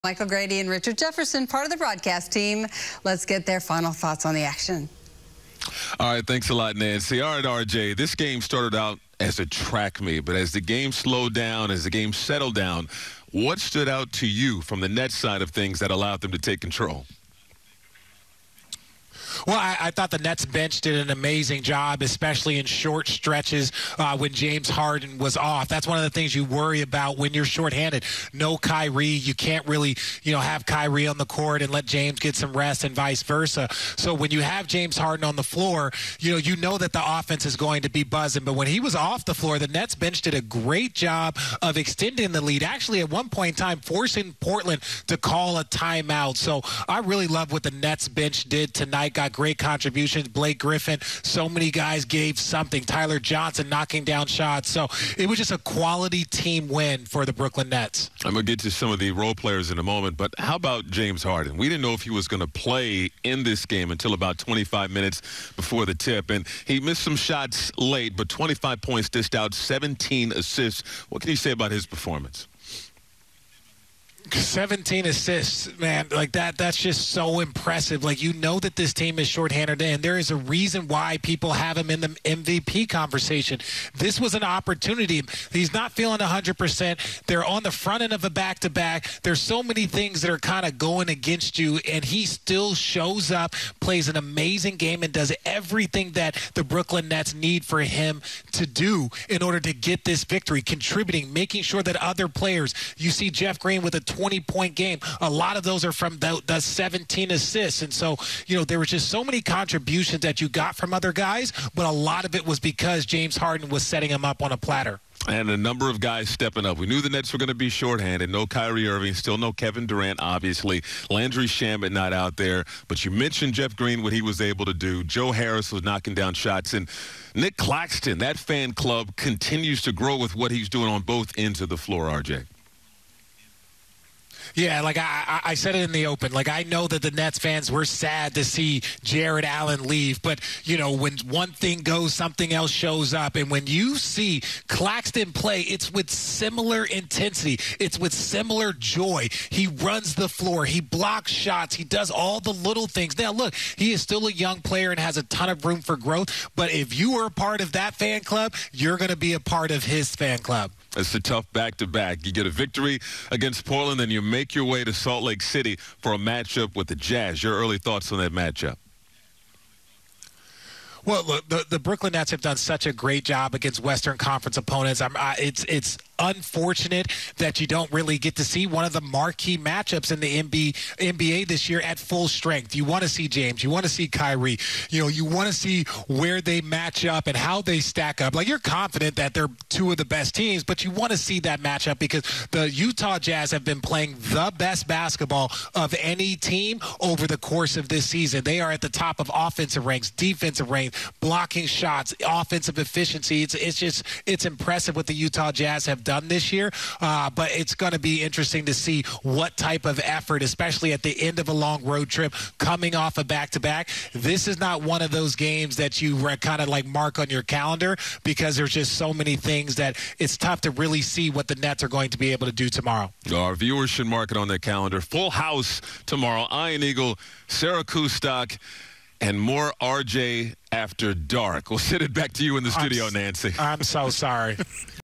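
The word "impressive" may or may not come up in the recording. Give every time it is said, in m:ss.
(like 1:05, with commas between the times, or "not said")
1:17, 3:24.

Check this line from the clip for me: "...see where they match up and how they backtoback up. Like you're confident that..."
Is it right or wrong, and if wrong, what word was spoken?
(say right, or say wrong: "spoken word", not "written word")
wrong: "stack", not "backtoback".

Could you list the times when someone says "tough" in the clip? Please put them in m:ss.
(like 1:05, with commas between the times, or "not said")
2:41, 3:40.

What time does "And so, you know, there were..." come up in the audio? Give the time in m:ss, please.
1:47.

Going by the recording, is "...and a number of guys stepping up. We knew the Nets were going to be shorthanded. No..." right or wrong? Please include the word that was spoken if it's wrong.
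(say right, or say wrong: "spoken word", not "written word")
right.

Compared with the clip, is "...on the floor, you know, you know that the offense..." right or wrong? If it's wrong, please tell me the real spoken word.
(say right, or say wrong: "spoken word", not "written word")
right.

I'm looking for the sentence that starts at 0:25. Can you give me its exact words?
That's one of the things you worry about when you're shorthanded.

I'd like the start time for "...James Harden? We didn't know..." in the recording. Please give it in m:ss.
1:00.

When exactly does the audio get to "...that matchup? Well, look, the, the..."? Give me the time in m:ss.
2:48.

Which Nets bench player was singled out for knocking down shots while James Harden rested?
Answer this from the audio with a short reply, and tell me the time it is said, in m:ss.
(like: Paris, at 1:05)
Tyler Johnson, at 0:52.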